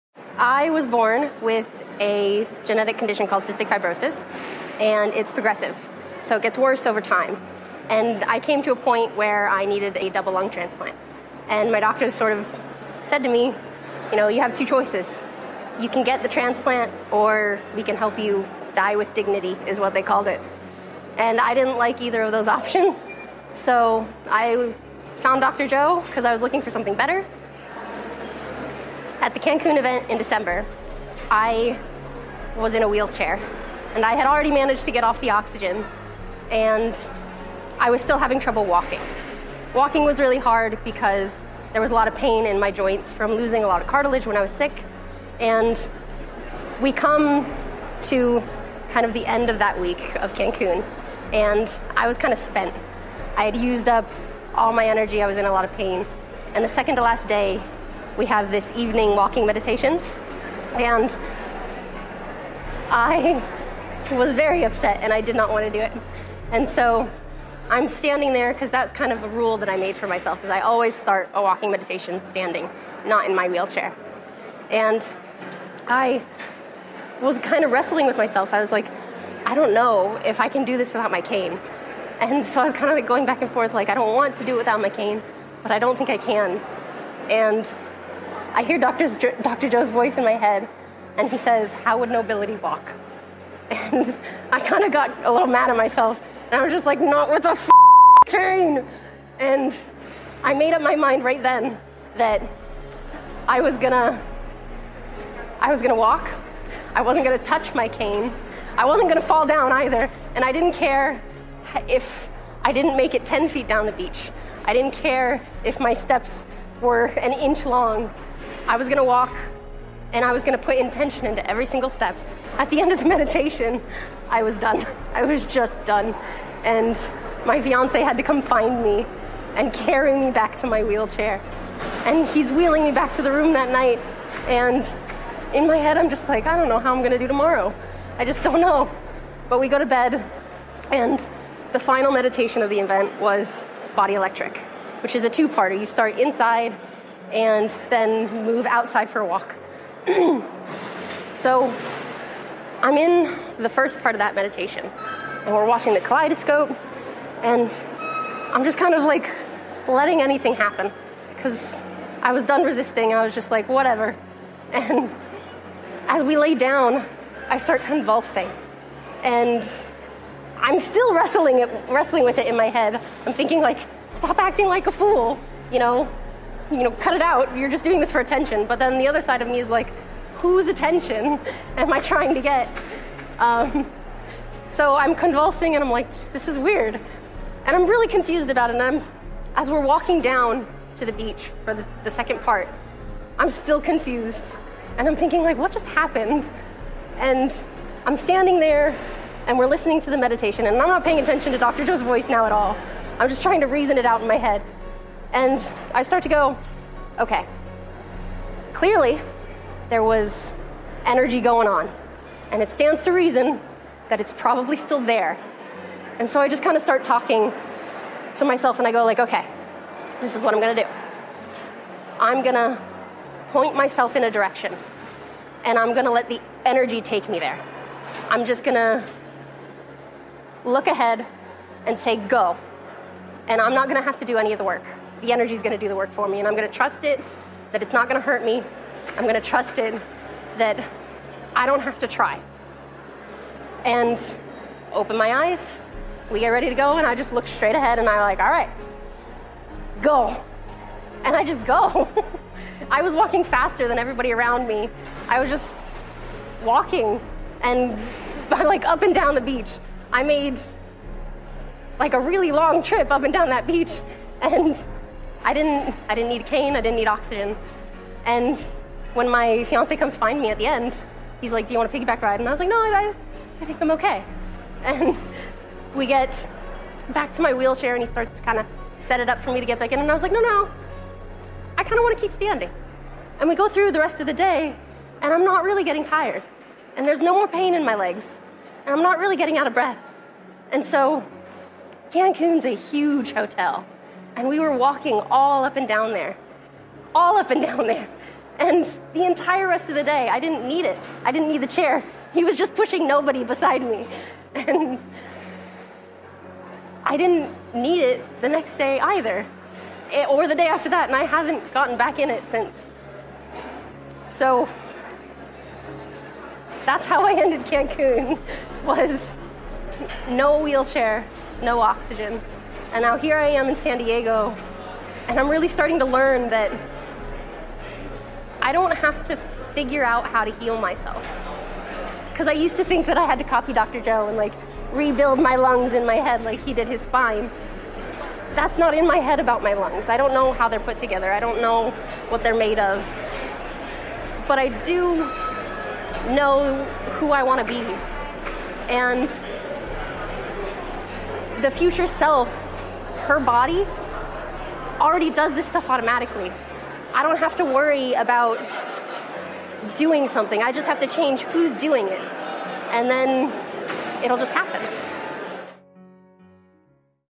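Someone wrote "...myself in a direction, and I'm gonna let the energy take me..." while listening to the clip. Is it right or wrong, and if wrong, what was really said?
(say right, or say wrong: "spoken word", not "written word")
right.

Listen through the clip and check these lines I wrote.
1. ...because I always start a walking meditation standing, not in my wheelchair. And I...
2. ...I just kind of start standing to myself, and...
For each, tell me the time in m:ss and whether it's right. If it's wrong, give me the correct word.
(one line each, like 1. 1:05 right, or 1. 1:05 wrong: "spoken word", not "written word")
1. 1:10 right
2. 3:36 wrong: "talking", not "standing".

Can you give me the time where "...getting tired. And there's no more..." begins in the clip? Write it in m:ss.
4:45.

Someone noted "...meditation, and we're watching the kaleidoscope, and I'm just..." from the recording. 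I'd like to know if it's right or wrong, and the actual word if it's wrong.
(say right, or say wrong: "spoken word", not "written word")
right.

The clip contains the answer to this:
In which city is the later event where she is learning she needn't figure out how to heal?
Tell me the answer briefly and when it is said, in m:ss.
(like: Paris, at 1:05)
San Diego, at 5:23.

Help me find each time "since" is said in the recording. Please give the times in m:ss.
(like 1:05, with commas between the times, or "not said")
5:12.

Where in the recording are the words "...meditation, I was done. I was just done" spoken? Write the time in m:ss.
2:03.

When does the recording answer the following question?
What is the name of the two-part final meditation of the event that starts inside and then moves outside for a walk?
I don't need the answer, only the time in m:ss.
2:23.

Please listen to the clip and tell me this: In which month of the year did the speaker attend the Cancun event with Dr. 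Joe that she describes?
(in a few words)
December.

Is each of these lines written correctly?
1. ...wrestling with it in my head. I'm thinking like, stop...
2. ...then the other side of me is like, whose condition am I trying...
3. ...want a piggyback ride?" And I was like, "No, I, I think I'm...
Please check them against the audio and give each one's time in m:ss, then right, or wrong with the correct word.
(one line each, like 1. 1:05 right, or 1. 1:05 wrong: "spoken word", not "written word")
1. 2:51 right
2. 2:58 wrong: "attention", not "condition"
3. 4:31 right.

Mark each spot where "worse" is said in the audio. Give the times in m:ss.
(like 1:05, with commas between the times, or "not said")
0:06.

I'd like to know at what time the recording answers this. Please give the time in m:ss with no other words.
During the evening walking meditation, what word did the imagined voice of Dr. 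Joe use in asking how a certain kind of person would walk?
1:32.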